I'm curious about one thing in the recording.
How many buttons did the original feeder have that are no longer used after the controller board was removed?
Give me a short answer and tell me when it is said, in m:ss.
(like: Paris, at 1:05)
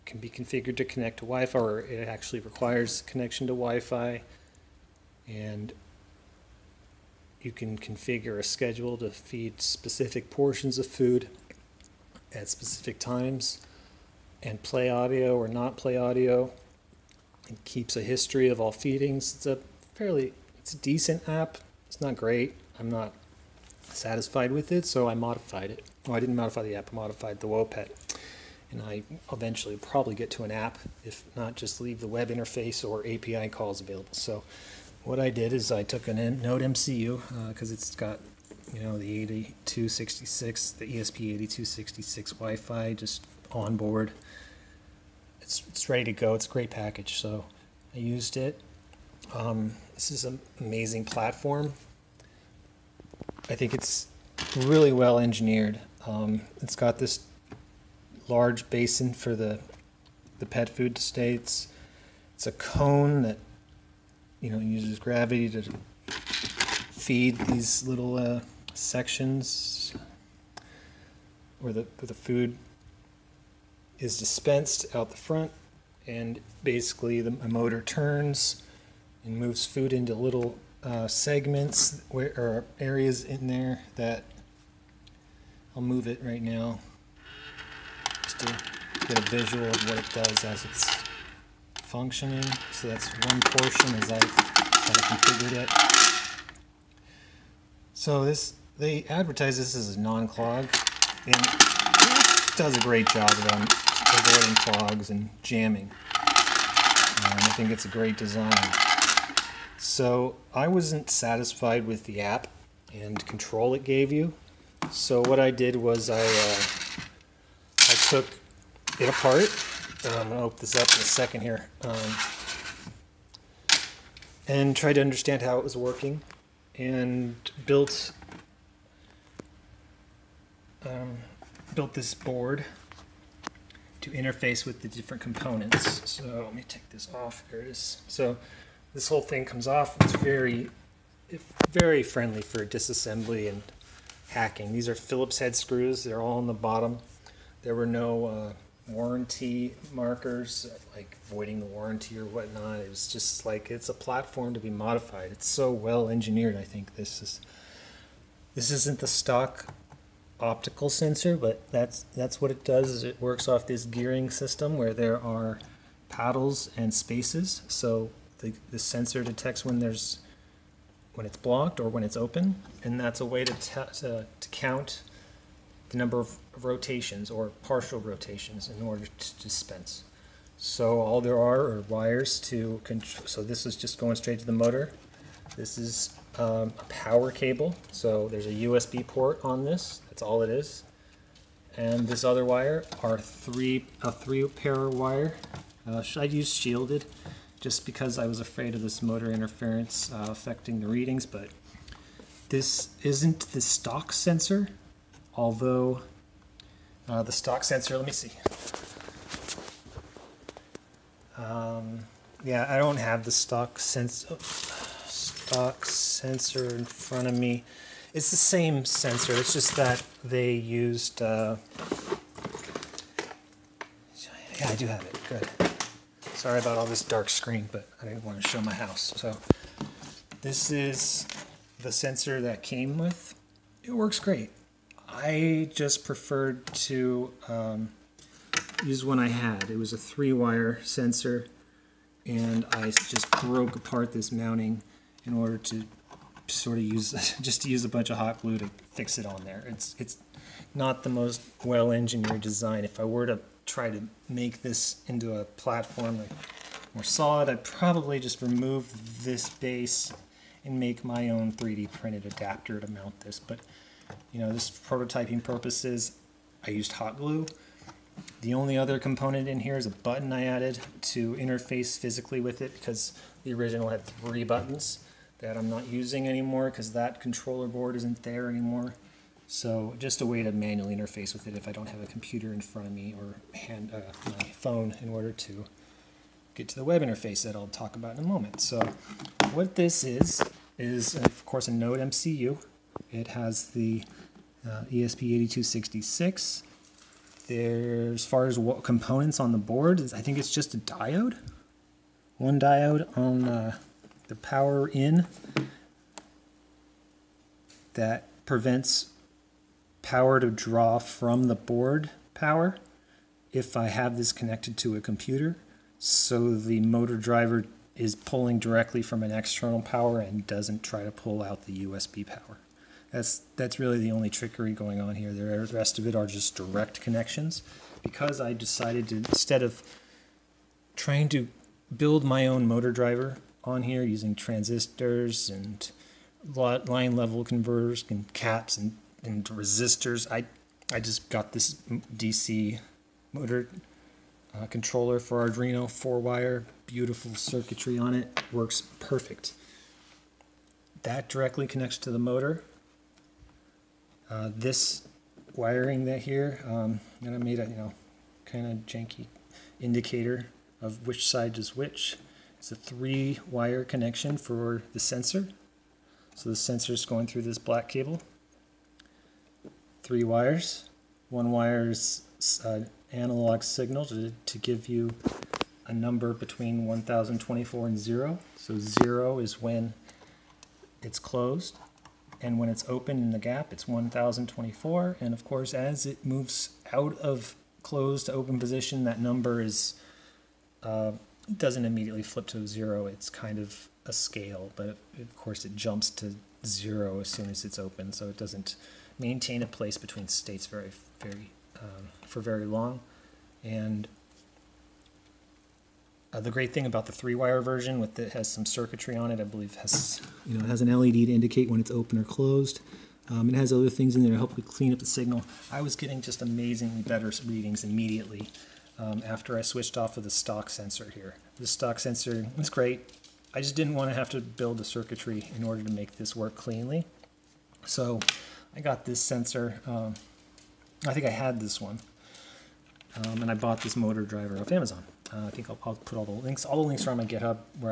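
3, at 4:34.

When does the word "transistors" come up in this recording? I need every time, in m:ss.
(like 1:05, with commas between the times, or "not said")
5:34.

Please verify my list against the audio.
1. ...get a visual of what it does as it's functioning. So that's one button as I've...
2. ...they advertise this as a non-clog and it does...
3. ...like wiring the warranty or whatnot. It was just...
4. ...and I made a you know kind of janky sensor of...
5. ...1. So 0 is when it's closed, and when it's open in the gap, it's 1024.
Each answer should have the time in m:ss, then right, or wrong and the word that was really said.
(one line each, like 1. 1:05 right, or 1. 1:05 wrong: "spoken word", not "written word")
1. 1:29 wrong: "portion", not "button"
2. 1:38 right
3. 2:30 wrong: "voiding", not "wiring"
4. 5:57 wrong: "indicator", not "sensor"
5. 6:17 wrong: "0", not "1".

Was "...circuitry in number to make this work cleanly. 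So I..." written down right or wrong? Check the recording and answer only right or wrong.
wrong.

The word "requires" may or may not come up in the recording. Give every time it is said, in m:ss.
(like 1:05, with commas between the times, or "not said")
0:02.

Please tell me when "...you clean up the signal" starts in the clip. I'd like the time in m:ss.
6:54.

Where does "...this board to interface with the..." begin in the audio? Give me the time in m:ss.
2:11.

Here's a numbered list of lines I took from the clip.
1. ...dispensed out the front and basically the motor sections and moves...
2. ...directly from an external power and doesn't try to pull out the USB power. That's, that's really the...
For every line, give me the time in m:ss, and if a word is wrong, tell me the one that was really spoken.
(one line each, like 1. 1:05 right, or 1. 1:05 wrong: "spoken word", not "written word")
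1. 1:14 wrong: "turns", not "sections"
2. 5:18 right.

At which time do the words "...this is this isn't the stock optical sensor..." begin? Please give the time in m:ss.
2:36.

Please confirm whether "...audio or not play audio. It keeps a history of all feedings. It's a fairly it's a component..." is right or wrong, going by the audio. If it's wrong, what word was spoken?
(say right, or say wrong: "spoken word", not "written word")
wrong: "decent", not "component".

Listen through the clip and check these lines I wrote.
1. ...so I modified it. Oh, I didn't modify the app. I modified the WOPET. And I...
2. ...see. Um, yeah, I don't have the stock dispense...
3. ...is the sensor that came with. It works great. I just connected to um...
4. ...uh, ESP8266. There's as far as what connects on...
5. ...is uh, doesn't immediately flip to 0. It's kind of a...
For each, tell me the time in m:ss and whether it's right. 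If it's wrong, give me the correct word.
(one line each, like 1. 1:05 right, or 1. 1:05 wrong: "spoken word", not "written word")
1. 0:24 right
2. 3:28 wrong: "sense", not "dispense"
3. 3:50 wrong: "preferred", not "connected"
4. 4:54 wrong: "components", not "connects"
5. 6:29 right.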